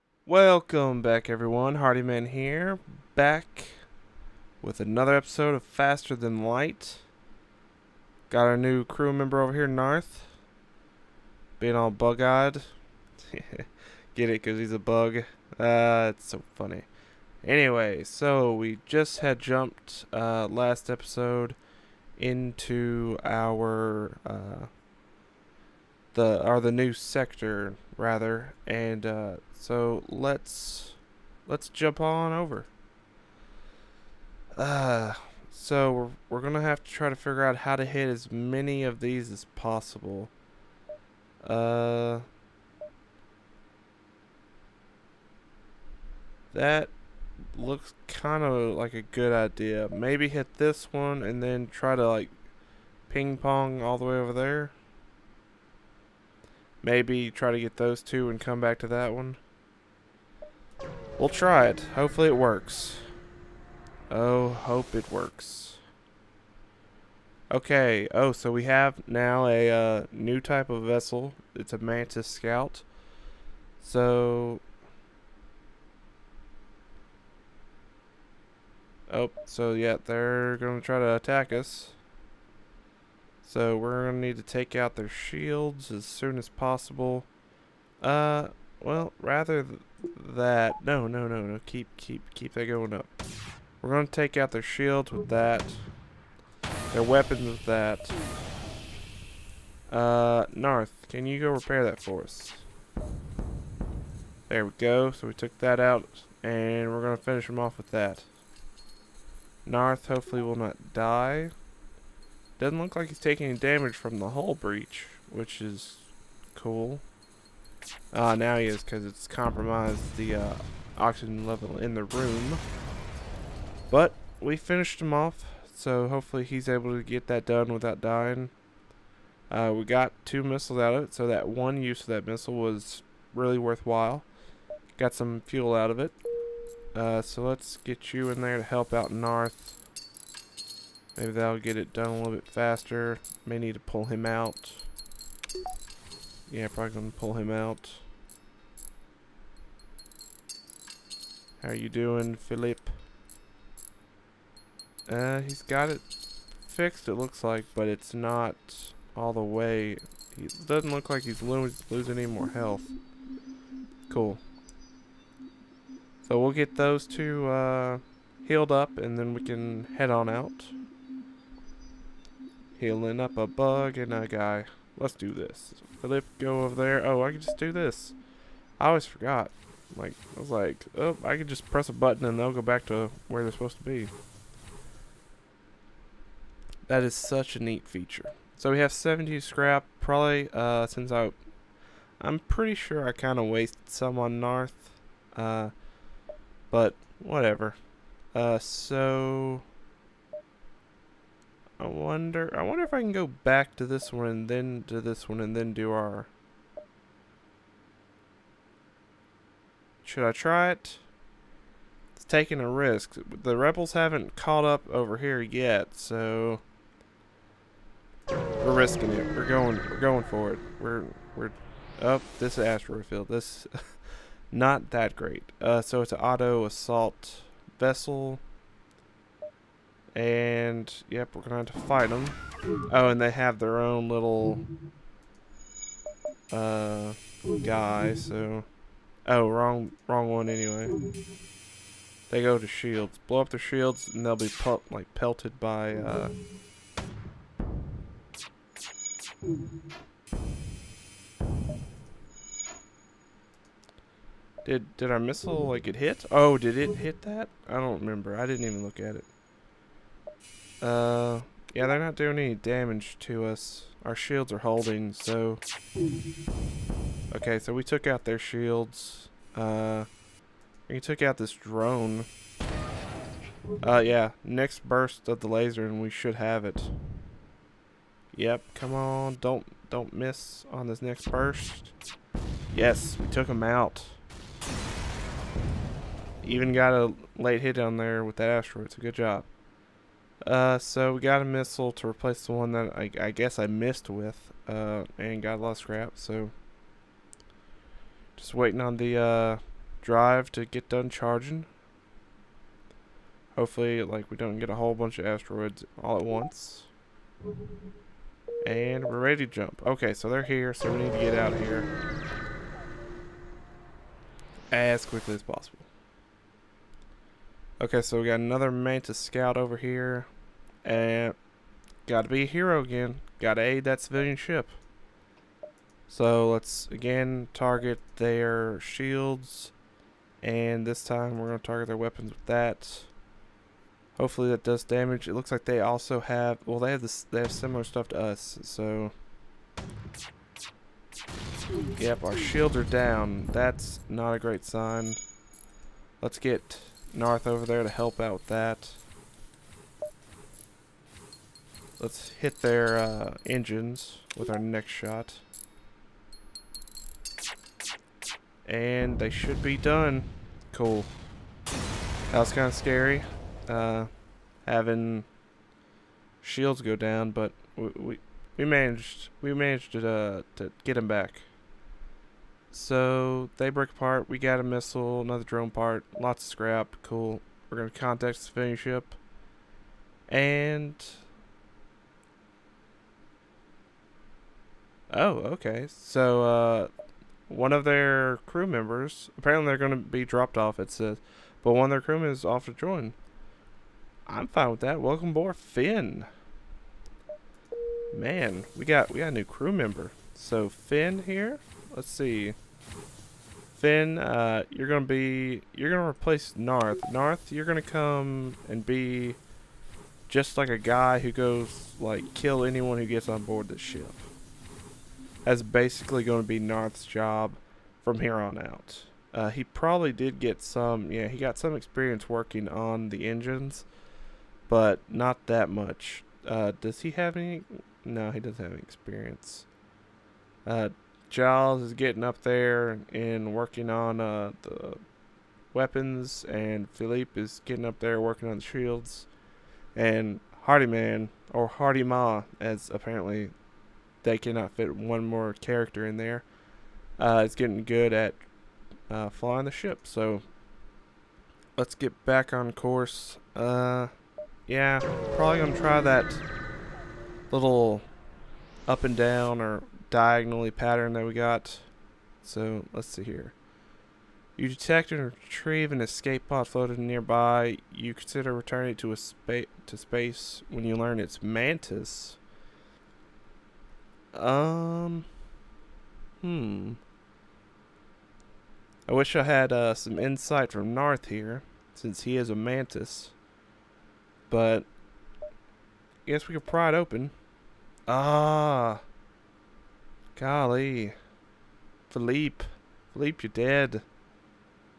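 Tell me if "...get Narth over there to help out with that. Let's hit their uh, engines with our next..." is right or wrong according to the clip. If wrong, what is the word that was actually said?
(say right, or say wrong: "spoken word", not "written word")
right.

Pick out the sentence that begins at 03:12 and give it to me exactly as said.
I'm pretty sure I kind of wasted some on Narth.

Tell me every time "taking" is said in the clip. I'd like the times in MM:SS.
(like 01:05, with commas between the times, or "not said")
01:53, 03:32.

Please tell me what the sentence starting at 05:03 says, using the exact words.
Hopefully, like, we don't get a whole bunch of asteroids all at once.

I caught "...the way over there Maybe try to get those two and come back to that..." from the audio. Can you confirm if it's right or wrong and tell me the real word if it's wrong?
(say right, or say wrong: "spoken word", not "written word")
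right.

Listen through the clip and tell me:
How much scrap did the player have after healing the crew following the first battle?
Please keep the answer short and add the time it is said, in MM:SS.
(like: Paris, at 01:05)
70, at 03:08.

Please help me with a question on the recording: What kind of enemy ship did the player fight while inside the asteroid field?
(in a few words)
Auto assault vessel.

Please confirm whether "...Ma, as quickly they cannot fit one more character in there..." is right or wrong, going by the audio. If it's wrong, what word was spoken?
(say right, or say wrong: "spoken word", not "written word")
wrong: "apparently", not "quickly".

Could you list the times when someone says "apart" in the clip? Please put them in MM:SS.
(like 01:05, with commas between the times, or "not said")
06:13.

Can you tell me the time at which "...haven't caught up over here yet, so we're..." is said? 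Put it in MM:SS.
03:33.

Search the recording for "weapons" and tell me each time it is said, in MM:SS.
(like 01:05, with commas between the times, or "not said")
01:37, 05:31, 07:15.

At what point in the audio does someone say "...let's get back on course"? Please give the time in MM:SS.
07:31.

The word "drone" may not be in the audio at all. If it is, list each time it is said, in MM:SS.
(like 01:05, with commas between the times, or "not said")
04:31, 06:15.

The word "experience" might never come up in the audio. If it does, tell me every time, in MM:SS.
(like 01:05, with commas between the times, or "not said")
07:01, 07:08.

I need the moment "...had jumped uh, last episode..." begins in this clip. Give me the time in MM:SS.
00:19.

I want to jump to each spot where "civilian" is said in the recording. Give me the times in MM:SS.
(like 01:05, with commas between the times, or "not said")
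05:23, 06:18.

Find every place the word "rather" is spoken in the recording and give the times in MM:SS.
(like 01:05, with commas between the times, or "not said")
00:27, 01:29.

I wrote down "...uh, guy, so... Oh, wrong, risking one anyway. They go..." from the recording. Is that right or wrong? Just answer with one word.
wrong.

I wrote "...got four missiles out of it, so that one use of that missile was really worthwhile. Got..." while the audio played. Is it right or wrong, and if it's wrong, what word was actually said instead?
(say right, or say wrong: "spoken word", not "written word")
wrong: "two", not "four".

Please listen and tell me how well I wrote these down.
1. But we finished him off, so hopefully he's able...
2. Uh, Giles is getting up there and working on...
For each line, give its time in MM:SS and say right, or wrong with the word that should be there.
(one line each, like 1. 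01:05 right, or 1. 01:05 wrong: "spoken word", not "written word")
1. 02:03 right
2. 07:10 right.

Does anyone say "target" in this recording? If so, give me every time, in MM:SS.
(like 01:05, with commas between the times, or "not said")
05:27, 05:31.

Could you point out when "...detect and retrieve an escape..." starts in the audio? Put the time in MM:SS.
07:44.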